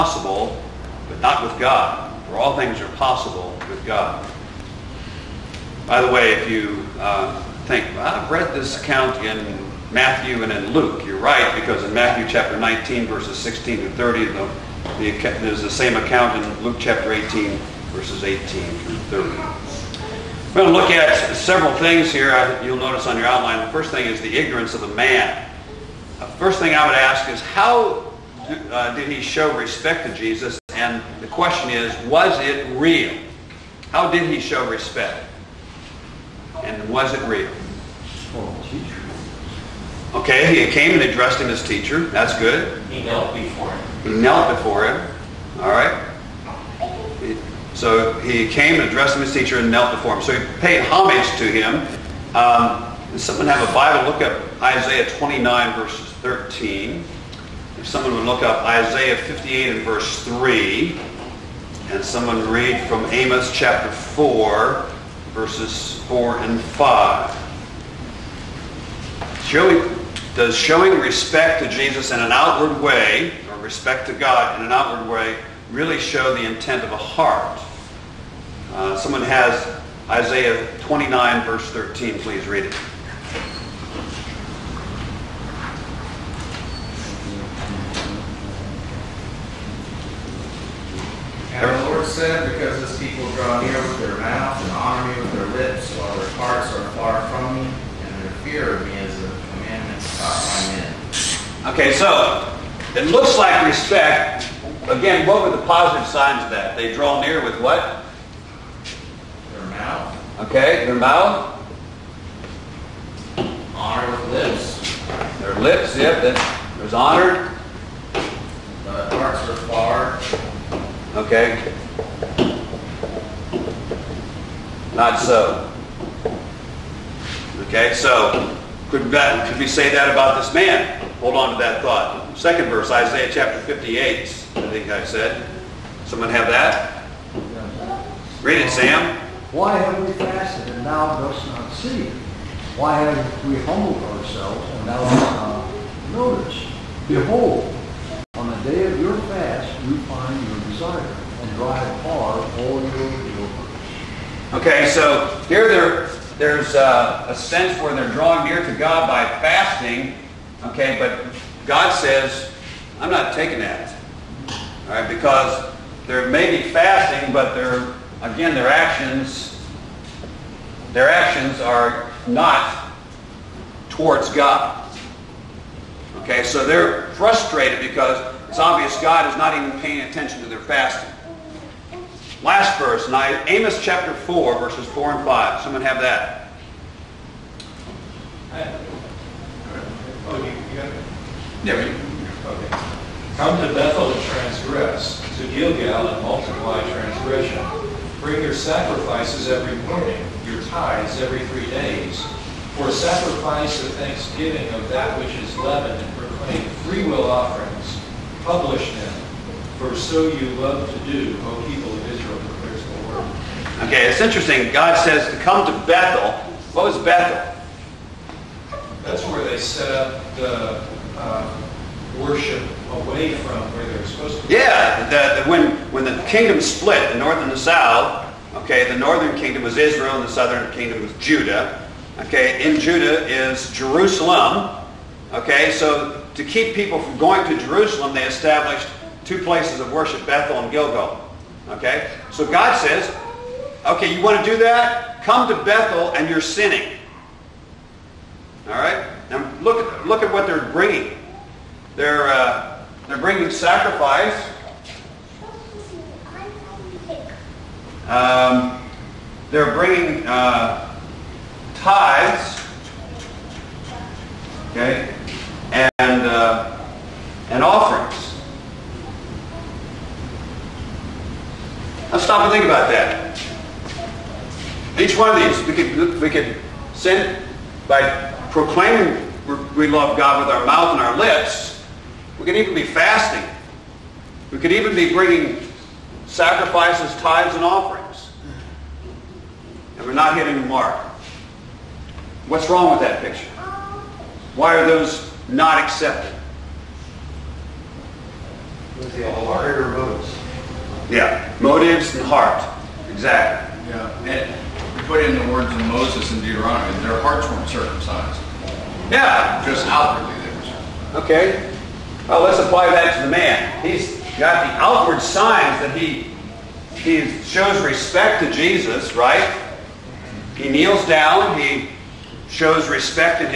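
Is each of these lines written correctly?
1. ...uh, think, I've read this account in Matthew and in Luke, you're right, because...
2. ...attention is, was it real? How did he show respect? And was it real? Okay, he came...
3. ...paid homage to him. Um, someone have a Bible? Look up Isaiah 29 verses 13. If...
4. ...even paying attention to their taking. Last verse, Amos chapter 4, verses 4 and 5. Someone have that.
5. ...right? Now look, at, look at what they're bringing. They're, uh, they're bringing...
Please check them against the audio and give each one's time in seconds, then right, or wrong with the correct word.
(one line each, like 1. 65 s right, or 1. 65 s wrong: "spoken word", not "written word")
1. 6 s right
2. 31 s wrong: "question", not "attention"
3. 50 s right
4. 179 s wrong: "fasting", not "taking"
5. 248 s right.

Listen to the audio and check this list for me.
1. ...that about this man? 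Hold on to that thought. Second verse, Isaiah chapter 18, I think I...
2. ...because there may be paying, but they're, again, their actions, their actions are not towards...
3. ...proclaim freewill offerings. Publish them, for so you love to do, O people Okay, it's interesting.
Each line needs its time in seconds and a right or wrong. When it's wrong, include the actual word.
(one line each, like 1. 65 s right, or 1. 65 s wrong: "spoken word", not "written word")
1. 129 s wrong: "58", not "18"
2. 165 s wrong: "fasting", not "paying"
3. 206 s right.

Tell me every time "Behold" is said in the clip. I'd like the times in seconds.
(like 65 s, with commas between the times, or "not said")
147 s.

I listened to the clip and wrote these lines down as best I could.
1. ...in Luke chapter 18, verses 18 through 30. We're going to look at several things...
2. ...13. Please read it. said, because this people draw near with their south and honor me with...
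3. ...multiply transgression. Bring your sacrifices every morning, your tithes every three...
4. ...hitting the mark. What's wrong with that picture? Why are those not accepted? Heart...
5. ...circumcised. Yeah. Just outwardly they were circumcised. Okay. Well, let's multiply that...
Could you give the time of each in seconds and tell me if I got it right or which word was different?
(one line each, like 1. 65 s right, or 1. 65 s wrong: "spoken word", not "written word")
1. 16 s right
2. 81 s wrong: "mouth", not "south"
3. 196 s right
4. 290 s right
5. 307 s wrong: "apply", not "multiply".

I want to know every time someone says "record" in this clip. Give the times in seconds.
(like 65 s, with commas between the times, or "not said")
not said.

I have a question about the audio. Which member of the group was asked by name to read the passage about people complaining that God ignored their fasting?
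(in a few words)
Sam.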